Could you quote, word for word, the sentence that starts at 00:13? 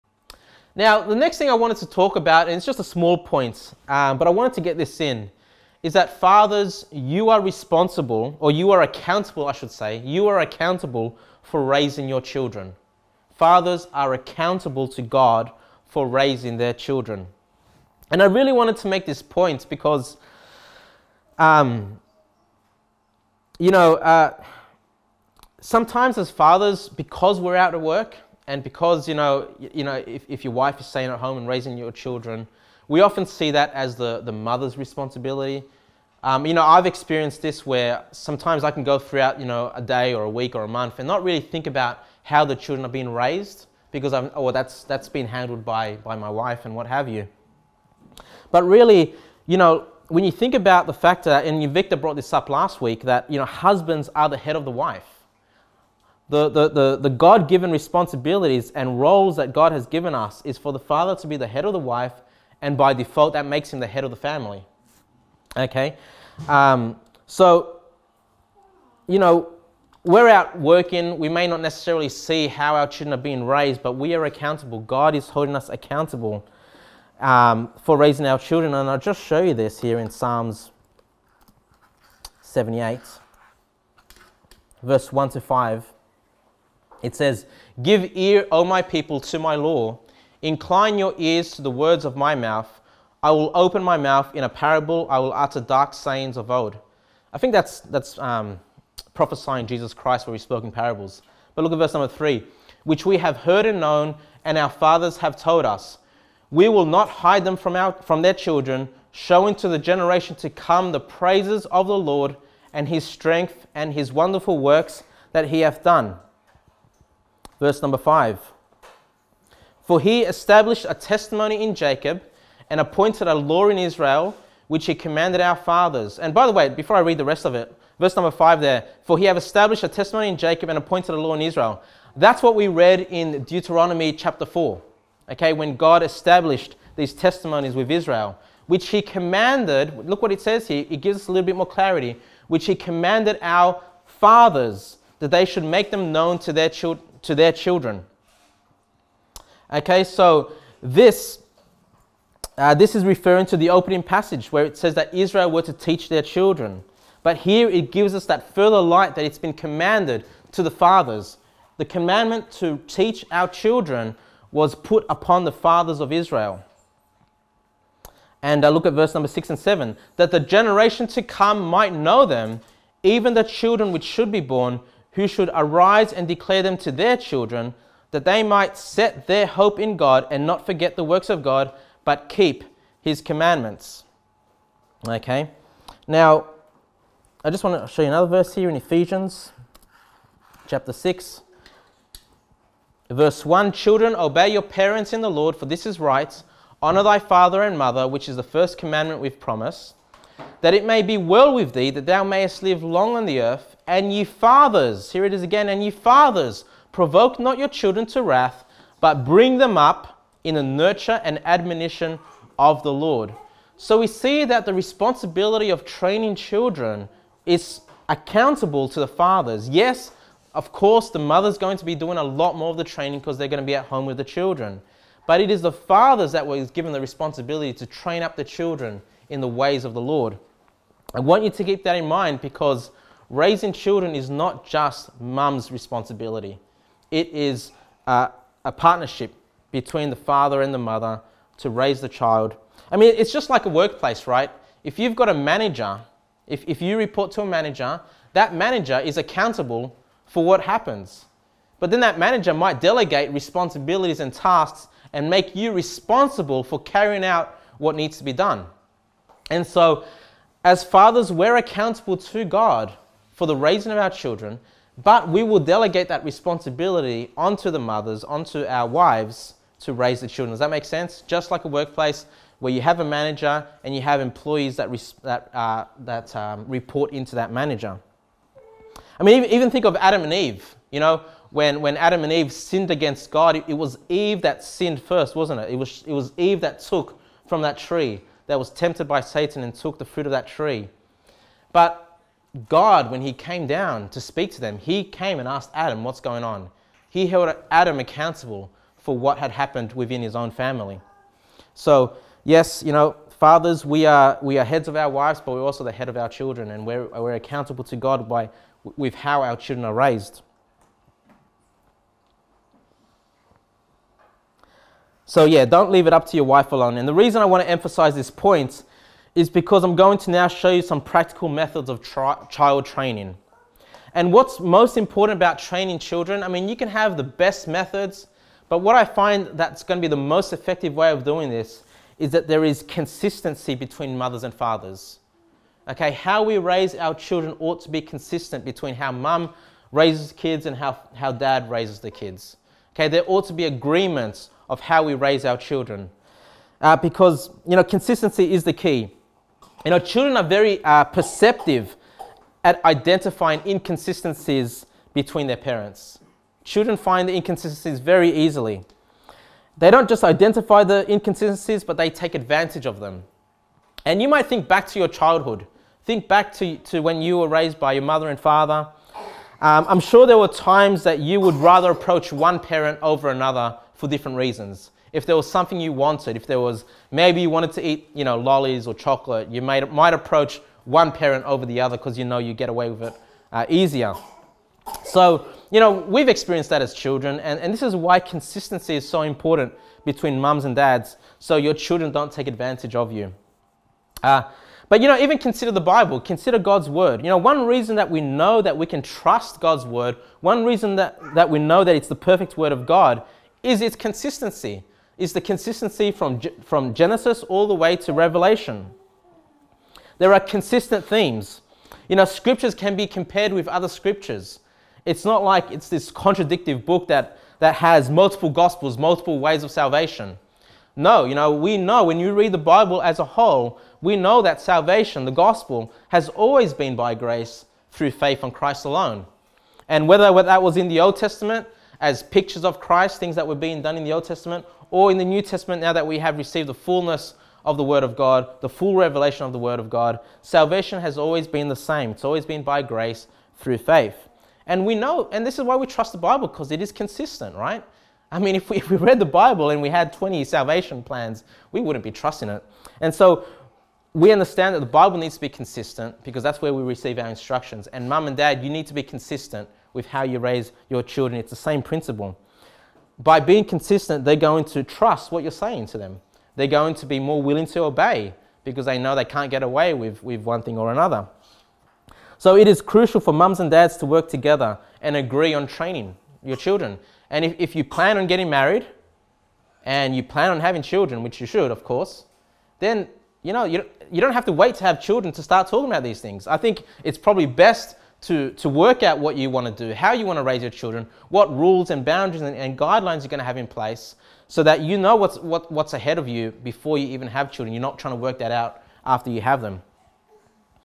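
Fathers are accountable to God for raising their children.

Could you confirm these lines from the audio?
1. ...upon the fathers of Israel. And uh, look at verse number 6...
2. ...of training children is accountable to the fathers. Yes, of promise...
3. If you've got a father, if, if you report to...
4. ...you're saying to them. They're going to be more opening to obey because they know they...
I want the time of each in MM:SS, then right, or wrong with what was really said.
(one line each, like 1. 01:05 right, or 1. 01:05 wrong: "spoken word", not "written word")
1. 02:45 right
2. 03:35 wrong: "course", not "promise"
3. 04:04 wrong: "manager", not "father"
4. 07:45 wrong: "willing", not "opening".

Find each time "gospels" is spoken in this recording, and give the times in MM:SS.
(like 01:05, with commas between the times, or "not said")
06:58, 07:05.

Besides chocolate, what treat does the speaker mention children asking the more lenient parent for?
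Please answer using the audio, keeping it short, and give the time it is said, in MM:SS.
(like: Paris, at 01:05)
Lollies, at 06:18.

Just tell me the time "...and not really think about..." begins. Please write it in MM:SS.
00:40.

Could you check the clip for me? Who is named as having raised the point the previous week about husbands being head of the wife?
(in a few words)
Victor.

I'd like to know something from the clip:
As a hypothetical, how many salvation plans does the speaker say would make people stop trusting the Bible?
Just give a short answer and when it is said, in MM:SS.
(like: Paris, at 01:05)
20, at 07:30.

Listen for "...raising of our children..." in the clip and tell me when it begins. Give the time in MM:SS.
04:23.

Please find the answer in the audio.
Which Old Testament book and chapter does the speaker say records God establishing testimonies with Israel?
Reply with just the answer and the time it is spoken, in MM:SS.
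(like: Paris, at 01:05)
Deuteronomy chapter 4, at 02:13.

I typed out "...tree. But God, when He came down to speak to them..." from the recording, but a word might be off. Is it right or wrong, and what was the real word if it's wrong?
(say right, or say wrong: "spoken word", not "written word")
right.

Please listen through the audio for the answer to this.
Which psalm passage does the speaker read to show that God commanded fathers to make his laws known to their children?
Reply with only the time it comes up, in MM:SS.
01:20.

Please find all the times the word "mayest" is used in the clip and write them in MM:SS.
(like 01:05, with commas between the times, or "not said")
03:22.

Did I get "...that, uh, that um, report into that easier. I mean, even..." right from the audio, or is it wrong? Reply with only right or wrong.
wrong.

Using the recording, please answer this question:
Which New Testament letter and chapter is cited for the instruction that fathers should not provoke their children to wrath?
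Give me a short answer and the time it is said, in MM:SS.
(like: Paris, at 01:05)
Ephesians chapter 6, at 03:08.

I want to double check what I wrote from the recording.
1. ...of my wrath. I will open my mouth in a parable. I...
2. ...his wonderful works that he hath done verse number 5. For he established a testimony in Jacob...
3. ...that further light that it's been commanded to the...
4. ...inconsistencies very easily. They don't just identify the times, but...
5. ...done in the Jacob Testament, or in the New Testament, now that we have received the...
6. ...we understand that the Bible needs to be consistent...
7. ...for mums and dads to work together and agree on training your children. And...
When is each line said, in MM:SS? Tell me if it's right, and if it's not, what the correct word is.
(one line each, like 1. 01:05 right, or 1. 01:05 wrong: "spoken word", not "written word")
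1. 01:32 wrong: "mouth", not "wrath"
2. 01:53 right
3. 02:38 right
4. 05:57 wrong: "inconsistencies", not "times"
5. 07:13 wrong: "Old", not "Jacob"
6. 07:34 right
7. 07:53 right.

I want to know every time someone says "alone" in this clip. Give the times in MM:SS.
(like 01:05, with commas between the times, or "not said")
05:16, 07:08.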